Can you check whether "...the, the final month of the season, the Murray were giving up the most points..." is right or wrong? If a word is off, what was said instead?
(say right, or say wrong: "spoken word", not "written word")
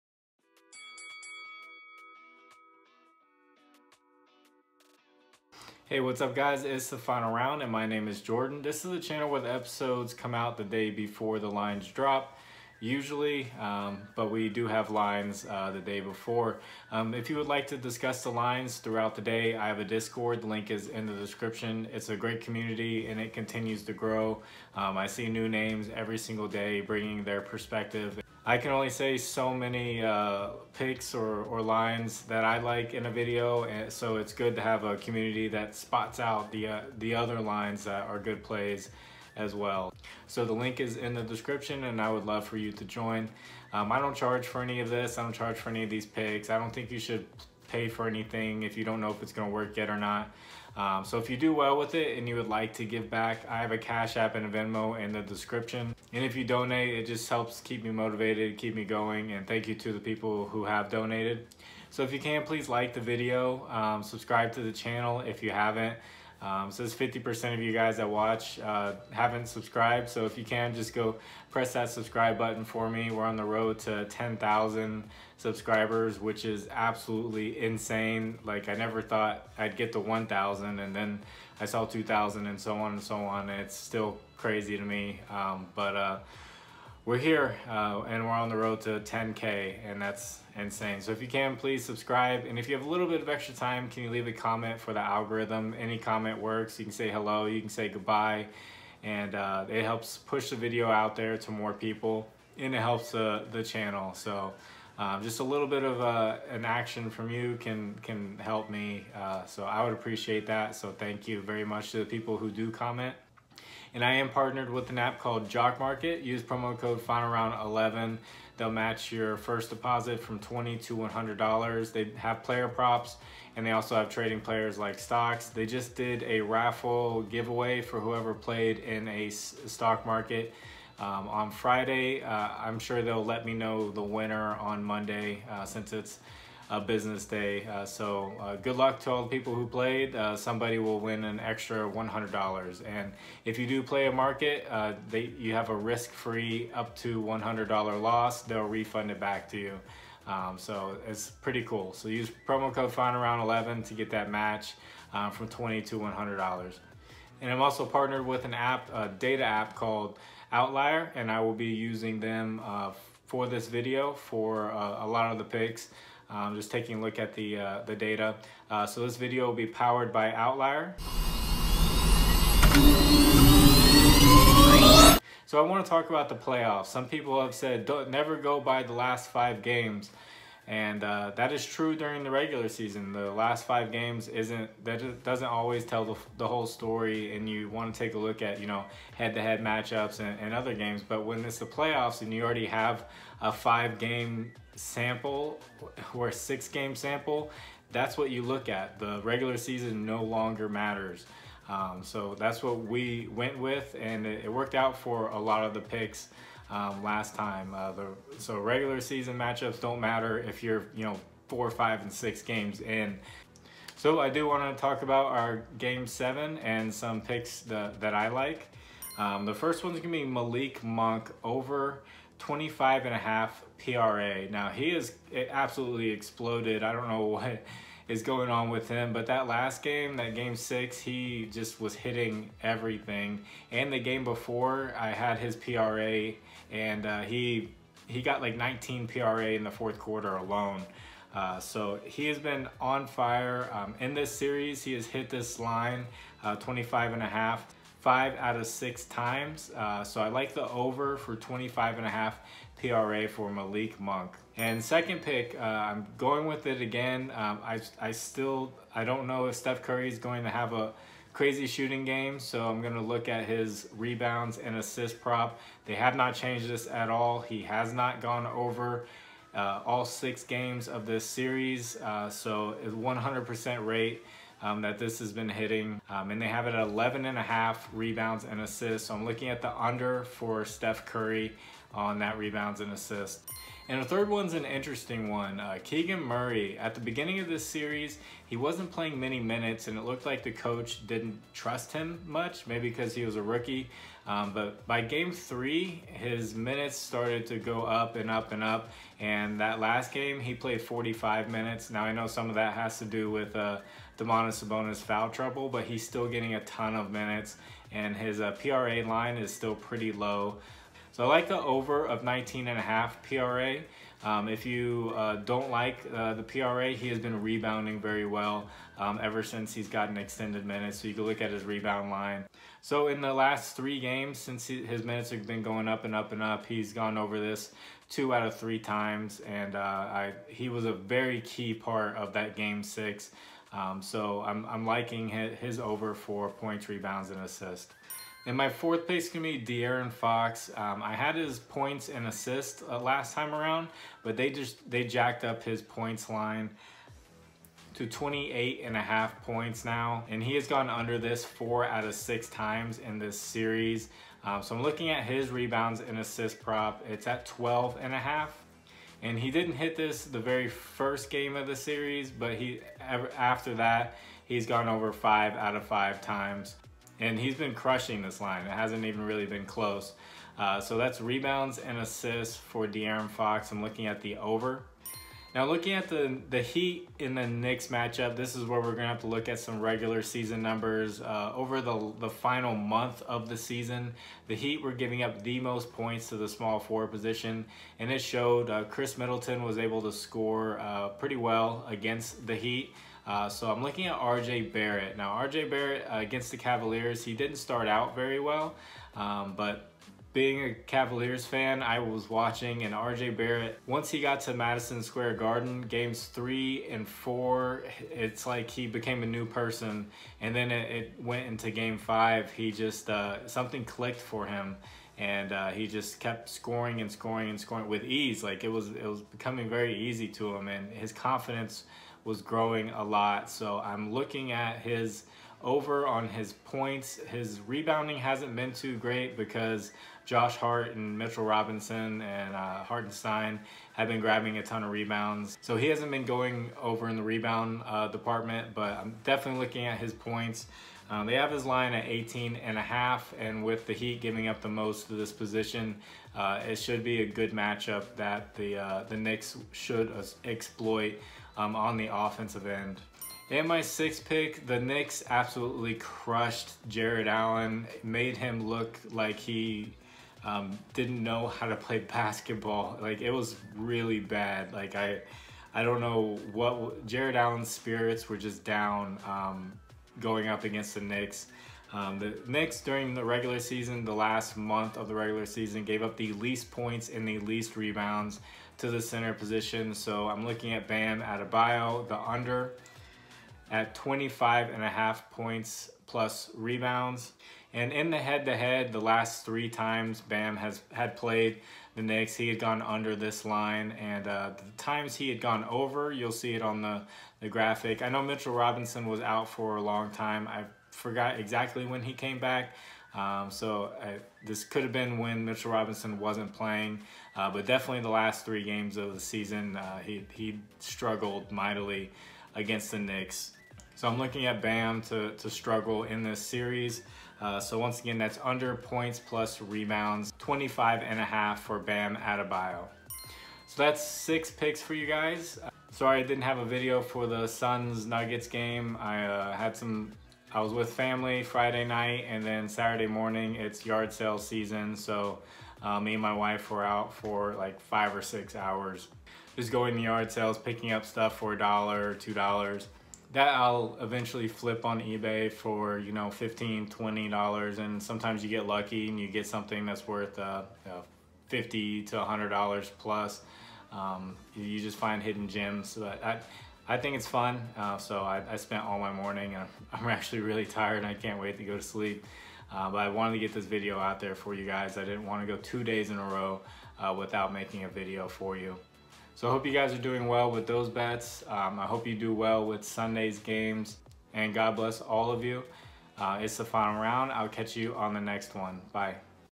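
wrong: "Heat", not "Murray".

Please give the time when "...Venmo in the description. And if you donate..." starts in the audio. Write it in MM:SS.
00:54.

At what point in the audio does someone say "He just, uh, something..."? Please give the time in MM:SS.
06:52.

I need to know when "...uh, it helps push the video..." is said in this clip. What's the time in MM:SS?
01:39.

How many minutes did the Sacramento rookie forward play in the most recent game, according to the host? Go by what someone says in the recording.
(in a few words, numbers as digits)
45.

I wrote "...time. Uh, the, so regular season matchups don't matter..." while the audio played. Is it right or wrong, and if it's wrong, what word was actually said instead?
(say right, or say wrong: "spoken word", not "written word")
right.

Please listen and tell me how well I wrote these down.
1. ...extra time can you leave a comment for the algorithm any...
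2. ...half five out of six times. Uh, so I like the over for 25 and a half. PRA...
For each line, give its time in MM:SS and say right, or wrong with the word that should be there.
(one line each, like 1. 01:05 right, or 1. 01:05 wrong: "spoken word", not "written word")
1. 01:33 right
2. 04:07 right.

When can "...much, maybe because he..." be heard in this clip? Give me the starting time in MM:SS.
04:52.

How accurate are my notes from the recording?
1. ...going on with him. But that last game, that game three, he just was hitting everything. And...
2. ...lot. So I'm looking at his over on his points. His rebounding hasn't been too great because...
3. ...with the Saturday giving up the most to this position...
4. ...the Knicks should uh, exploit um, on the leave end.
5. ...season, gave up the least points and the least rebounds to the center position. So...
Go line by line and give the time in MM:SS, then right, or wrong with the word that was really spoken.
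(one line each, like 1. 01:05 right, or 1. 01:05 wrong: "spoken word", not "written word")
1. 03:48 wrong: "six", not "three"
2. 07:03 right
3. 07:23 wrong: "Heat", not "Saturday"
4. 07:29 wrong: "offensive", not "leave"
5. 07:55 right.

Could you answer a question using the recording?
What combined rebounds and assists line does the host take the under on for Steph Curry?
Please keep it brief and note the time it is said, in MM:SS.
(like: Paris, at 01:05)
11.5, at 04:36.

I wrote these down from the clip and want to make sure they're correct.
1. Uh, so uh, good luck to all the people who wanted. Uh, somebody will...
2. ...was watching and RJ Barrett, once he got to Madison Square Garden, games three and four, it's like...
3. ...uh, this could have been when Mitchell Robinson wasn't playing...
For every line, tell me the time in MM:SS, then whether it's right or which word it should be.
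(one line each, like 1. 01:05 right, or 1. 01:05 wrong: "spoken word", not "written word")
1. 02:17 wrong: "played", not "wanted"
2. 06:41 right
3. 08:24 right.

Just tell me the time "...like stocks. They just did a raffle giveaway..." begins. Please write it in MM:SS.
02:04.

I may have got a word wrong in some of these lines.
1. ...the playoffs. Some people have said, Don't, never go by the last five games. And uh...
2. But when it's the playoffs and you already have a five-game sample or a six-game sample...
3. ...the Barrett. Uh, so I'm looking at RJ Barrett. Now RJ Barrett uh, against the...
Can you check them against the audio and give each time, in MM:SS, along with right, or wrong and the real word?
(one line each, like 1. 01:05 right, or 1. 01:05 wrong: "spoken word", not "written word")
1. 02:56 right
2. 03:11 right
3. 06:32 wrong: "Heat", not "Barrett".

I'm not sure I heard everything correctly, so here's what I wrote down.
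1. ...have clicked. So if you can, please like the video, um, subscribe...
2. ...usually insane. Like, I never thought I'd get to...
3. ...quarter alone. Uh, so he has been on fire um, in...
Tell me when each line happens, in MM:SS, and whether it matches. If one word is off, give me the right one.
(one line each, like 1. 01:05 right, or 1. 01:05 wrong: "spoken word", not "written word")
1. 01:00 wrong: "donated", not "clicked"
2. 01:16 wrong: "absolutely", not "usually"
3. 03:59 right.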